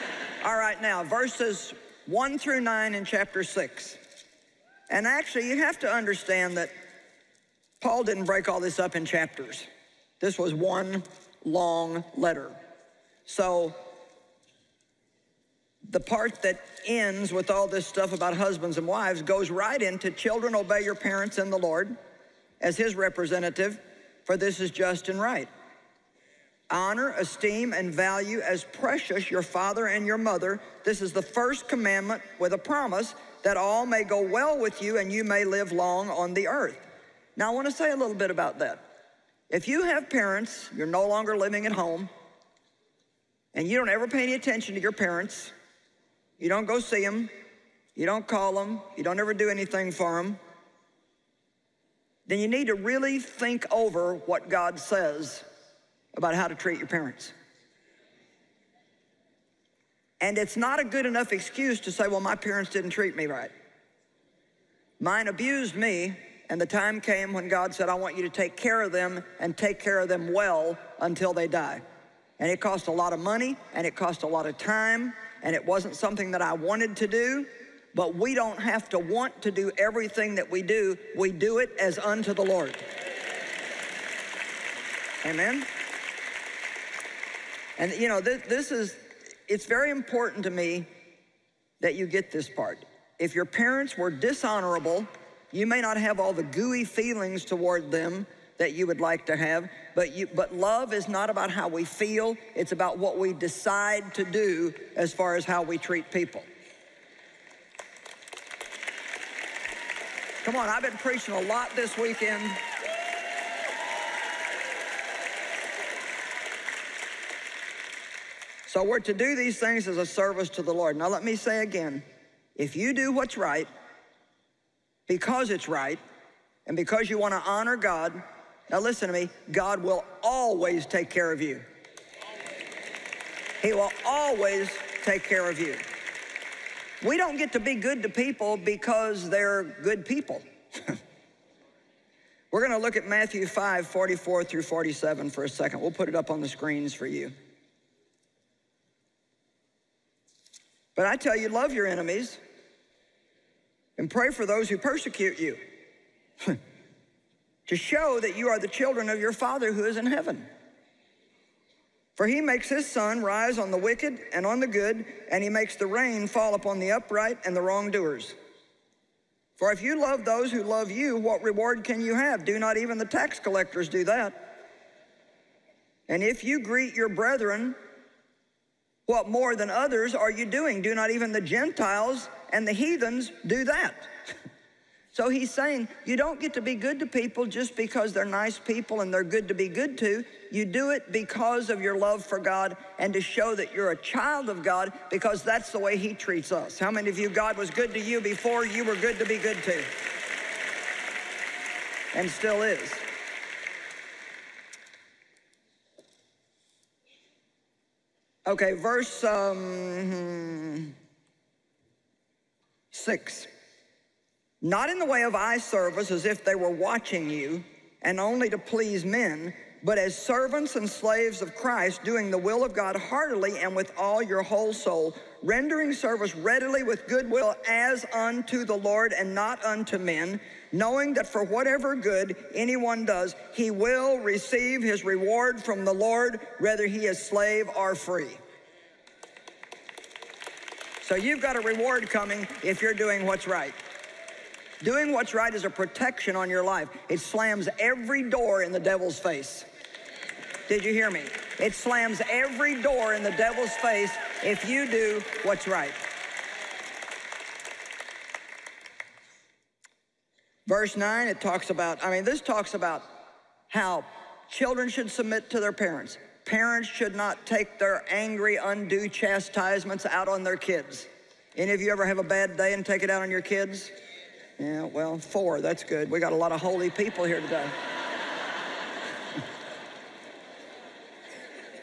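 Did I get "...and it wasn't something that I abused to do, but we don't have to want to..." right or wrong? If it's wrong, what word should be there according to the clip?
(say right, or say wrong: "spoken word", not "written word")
wrong: "wanted", not "abused".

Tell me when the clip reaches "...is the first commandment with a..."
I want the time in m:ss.
0:31.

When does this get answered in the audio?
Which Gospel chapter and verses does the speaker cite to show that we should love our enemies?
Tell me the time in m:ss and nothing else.
2:23.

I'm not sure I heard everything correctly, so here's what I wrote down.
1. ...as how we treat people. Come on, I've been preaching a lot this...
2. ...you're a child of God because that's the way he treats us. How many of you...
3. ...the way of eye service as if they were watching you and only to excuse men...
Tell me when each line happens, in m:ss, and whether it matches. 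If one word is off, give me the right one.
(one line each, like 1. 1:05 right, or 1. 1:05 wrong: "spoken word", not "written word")
1. 1:45 right
2. 3:13 right
3. 3:34 wrong: "please", not "excuse".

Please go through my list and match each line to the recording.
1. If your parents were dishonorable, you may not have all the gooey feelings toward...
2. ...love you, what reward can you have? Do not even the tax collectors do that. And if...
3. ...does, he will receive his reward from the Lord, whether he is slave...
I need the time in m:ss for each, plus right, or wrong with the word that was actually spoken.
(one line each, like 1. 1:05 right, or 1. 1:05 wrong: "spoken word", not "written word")
1. 1:33 right
2. 2:50 right
3. 3:53 right.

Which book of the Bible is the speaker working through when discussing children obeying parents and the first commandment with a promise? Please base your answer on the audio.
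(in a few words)
Chapter 6.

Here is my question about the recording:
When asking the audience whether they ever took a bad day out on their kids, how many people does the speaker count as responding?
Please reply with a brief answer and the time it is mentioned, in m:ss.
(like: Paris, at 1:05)
4, at 4:35.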